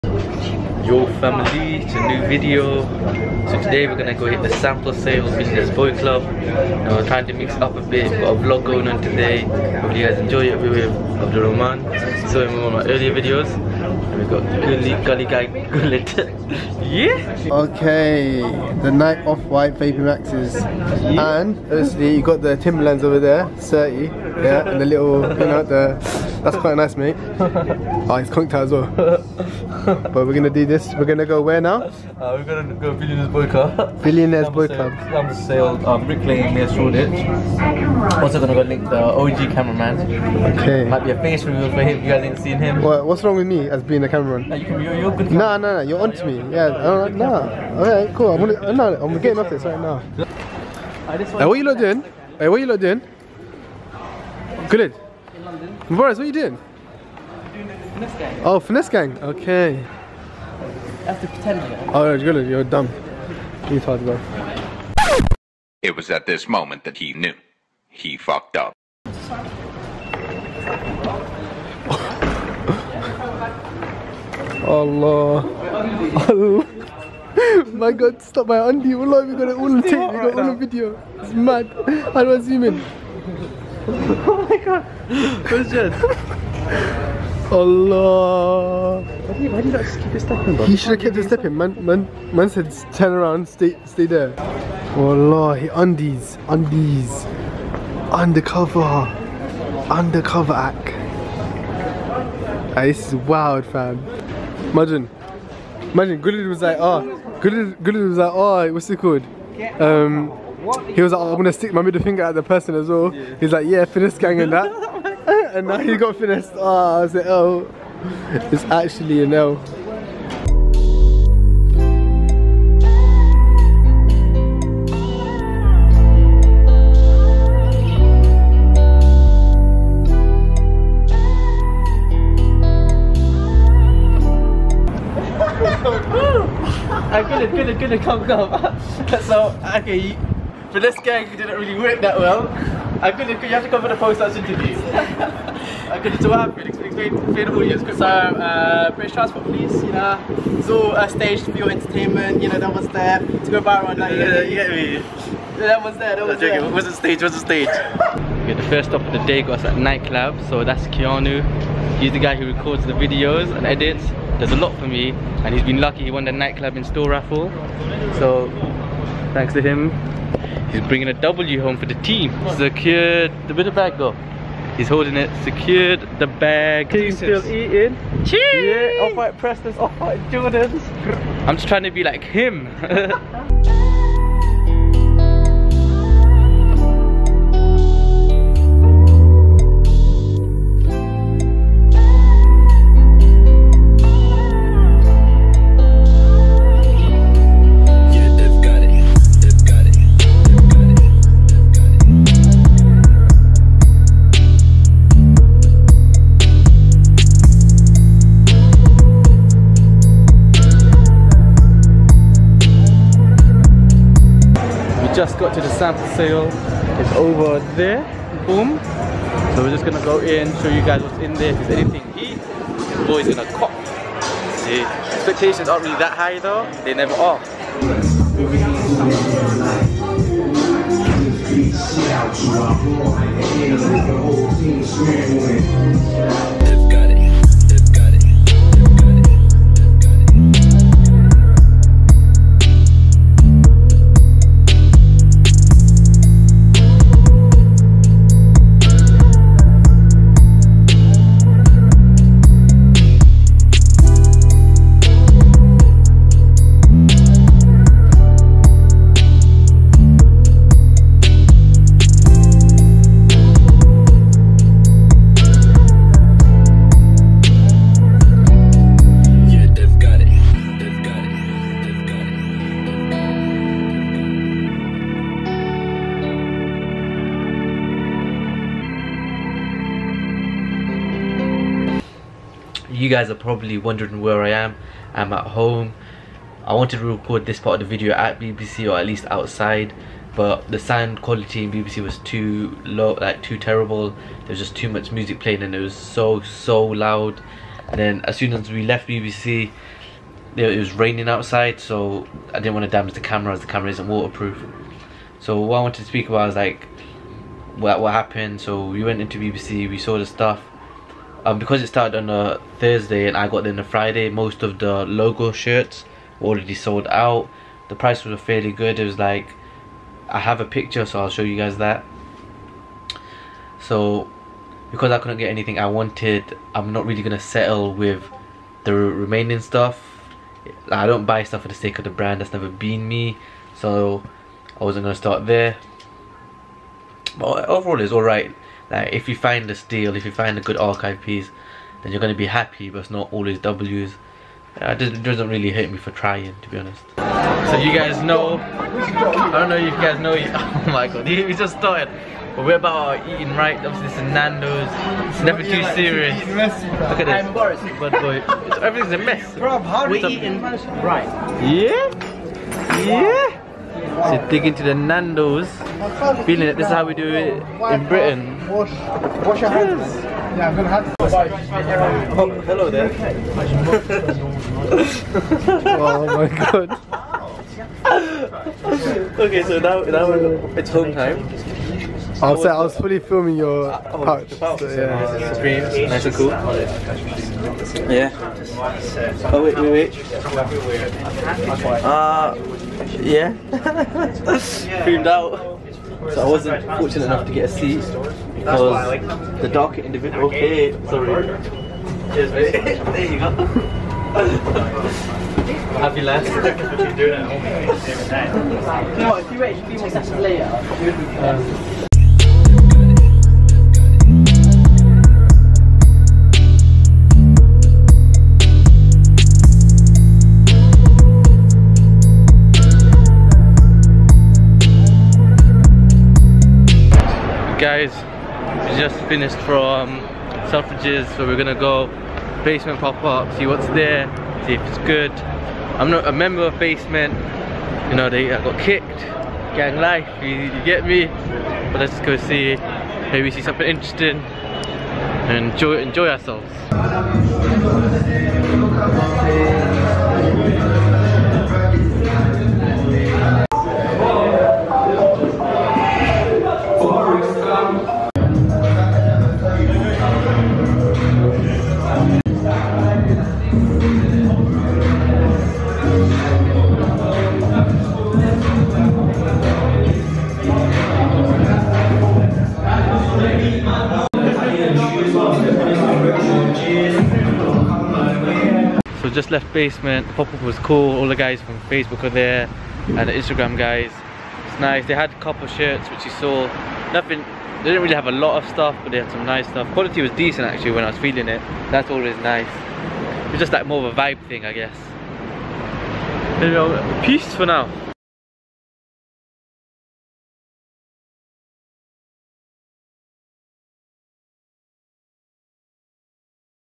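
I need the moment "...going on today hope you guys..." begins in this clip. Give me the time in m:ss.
0:08.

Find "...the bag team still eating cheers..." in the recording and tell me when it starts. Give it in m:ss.
2:56.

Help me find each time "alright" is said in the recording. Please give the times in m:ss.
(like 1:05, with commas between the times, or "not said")
5:38.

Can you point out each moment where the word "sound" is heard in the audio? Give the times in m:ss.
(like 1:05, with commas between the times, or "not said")
4:50.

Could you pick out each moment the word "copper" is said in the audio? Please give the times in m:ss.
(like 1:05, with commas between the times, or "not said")
8:05.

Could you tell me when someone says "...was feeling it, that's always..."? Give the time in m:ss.
8:11.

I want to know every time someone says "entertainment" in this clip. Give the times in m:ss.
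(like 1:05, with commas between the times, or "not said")
2:31.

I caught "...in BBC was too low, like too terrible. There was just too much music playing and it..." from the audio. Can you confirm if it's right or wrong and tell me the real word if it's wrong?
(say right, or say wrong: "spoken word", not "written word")
right.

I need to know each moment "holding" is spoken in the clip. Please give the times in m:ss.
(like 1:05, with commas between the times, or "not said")
2:54.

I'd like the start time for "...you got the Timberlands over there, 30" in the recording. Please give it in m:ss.
0:22.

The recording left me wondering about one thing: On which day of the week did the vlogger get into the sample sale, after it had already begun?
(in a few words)
Friday.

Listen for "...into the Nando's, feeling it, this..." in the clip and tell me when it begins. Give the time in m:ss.
6:04.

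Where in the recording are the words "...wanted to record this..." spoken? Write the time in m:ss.
4:46.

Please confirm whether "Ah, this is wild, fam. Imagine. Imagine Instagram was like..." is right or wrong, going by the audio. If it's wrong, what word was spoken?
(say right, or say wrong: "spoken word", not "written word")
wrong: "Gulid", not "Instagram".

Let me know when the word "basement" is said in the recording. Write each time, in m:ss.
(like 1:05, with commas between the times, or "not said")
7:12, 7:16, 7:59.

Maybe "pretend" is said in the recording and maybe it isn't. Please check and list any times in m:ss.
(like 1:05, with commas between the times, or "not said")
1:01.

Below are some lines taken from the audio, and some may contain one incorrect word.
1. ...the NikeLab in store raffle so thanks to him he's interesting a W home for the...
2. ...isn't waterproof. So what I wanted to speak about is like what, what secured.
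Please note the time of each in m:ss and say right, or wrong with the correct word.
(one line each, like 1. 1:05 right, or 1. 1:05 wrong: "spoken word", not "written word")
1. 2:46 wrong: "bringing", not "interesting"
2. 5:03 wrong: "happened", not "secured".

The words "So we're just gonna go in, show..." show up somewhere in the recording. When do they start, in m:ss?
3:39.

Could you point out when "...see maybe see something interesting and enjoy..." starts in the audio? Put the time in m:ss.
7:22.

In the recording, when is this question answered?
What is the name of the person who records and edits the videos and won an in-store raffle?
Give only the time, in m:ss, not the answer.
2:40.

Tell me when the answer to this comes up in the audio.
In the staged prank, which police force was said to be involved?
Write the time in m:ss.
2:28.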